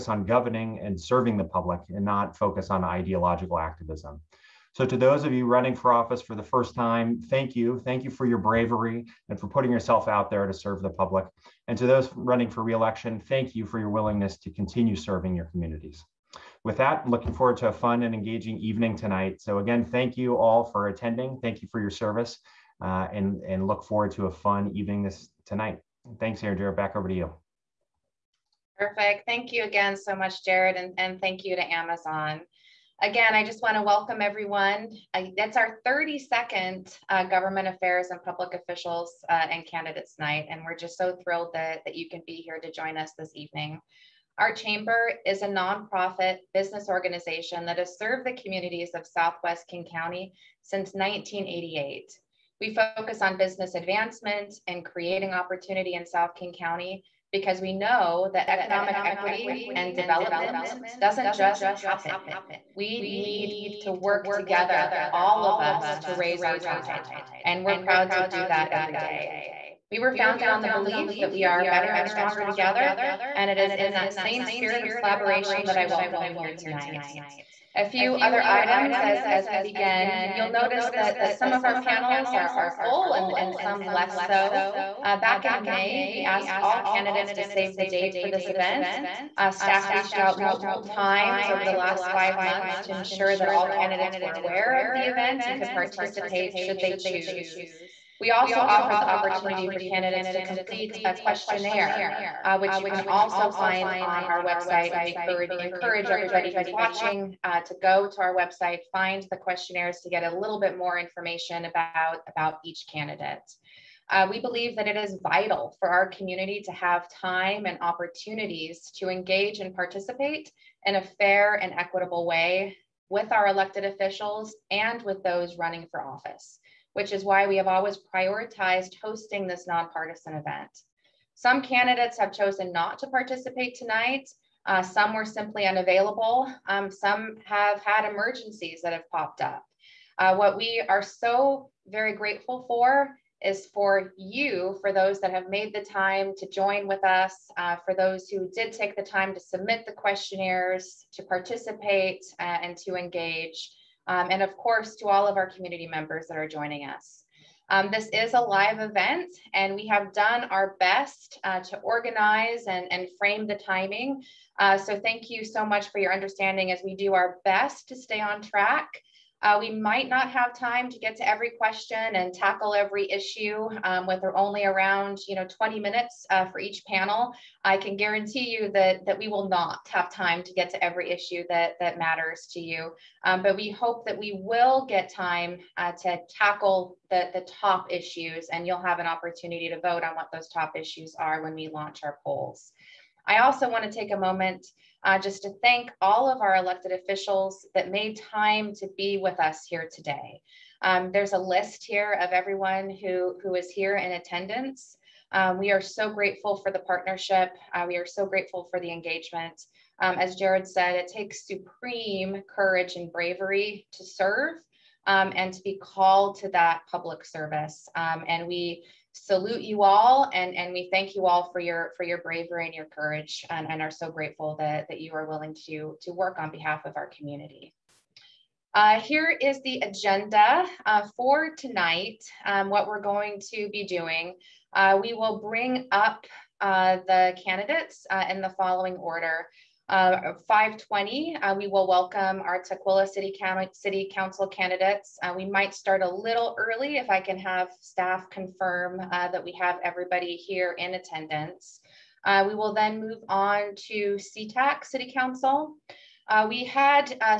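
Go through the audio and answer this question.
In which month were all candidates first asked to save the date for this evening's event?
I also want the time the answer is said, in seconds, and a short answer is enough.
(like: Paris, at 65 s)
May, at 85 s.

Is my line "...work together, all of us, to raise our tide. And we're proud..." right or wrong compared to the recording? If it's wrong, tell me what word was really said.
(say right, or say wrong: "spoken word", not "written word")
right.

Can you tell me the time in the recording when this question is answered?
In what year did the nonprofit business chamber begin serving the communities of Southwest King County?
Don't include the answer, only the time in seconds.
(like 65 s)
50 s.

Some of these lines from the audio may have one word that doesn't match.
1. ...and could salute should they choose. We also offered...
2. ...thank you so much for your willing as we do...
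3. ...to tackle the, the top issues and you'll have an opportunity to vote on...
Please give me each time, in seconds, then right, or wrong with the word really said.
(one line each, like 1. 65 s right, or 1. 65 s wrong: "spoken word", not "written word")
1. 95 s wrong: "participate", not "salute"
2. 164 s wrong: "understanding", not "willing"
3. 186 s right.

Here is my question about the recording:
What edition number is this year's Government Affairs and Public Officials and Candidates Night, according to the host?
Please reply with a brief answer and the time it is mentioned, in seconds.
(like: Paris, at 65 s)
32nd, at 35 s.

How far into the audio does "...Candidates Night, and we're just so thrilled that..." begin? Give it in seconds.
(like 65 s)
39 s.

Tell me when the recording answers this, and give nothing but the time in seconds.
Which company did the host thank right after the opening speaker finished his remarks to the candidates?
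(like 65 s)
31 s.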